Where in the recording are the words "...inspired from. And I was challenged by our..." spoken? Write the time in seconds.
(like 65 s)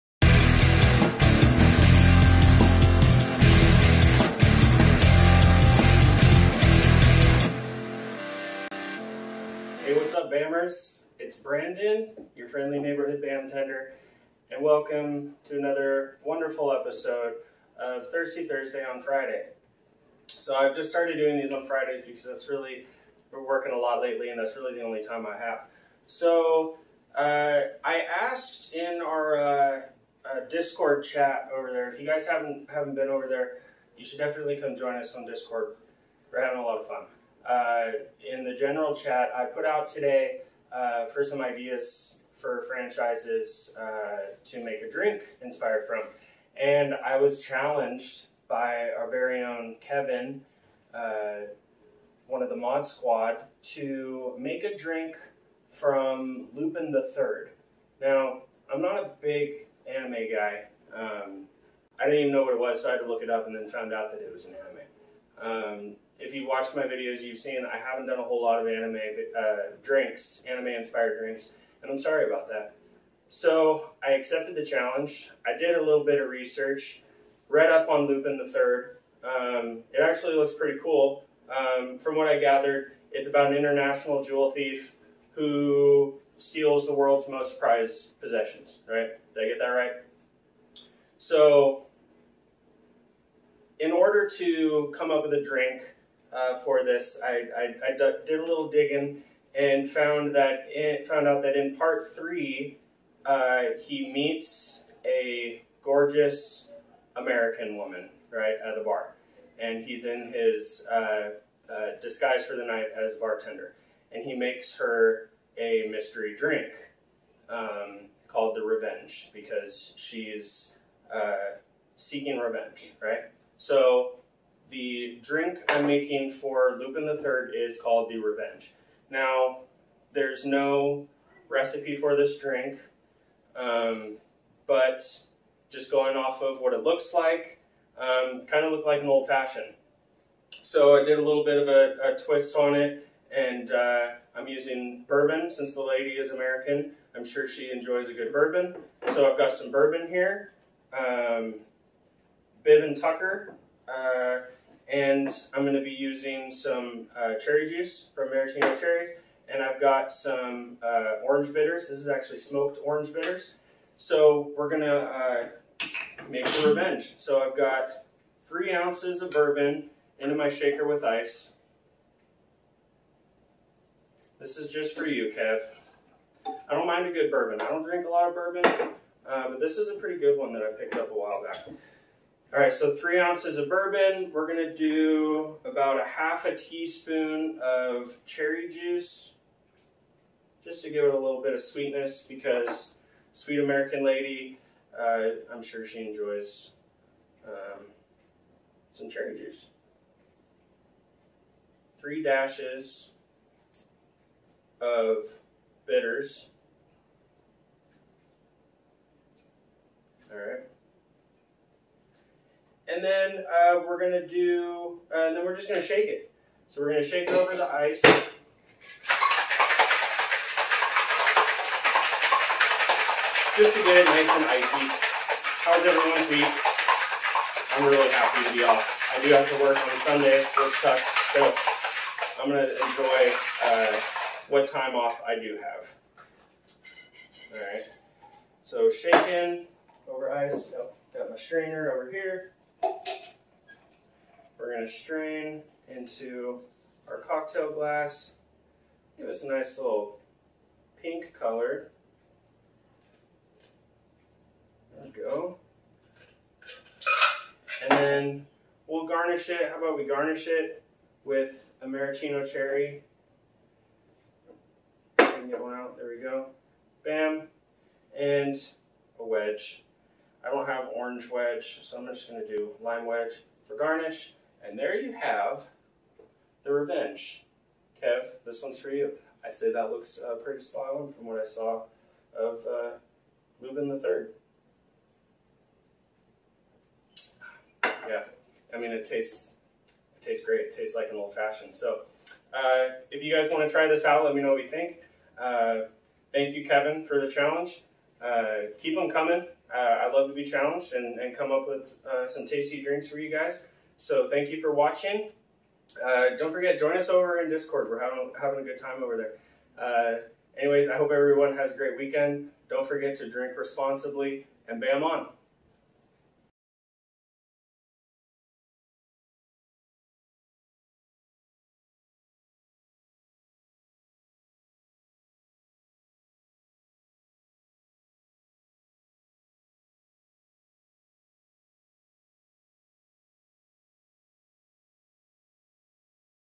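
45 s.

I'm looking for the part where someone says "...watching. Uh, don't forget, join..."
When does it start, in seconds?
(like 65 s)
304 s.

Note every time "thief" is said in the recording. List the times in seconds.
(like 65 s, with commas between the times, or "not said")
84 s.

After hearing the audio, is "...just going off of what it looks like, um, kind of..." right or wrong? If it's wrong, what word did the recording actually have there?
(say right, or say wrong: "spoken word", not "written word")
right.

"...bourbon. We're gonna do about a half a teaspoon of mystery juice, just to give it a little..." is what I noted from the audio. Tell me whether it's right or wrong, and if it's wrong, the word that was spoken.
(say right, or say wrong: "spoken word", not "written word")
wrong: "cherry", not "mystery".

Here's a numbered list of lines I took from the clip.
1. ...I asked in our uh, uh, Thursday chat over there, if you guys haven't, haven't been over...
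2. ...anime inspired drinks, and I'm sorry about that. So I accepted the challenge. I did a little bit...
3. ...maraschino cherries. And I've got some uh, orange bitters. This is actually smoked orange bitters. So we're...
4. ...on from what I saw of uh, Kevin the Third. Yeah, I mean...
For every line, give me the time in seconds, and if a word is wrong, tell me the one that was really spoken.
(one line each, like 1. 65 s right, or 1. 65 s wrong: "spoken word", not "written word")
1. 27 s wrong: "Discord", not "Thursday"
2. 70 s right
3. 158 s right
4. 280 s wrong: "Lupin", not "Kevin".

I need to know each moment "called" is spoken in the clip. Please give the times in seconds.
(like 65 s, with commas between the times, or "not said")
118 s, 127 s.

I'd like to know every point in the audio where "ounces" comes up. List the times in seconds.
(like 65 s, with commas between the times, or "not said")
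168 s, 183 s.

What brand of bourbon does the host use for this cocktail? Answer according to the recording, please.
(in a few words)
Bib and Tucker.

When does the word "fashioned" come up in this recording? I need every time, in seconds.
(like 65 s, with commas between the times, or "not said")
139 s, 291 s.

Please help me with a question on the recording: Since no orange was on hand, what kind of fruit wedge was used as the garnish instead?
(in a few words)
Lime.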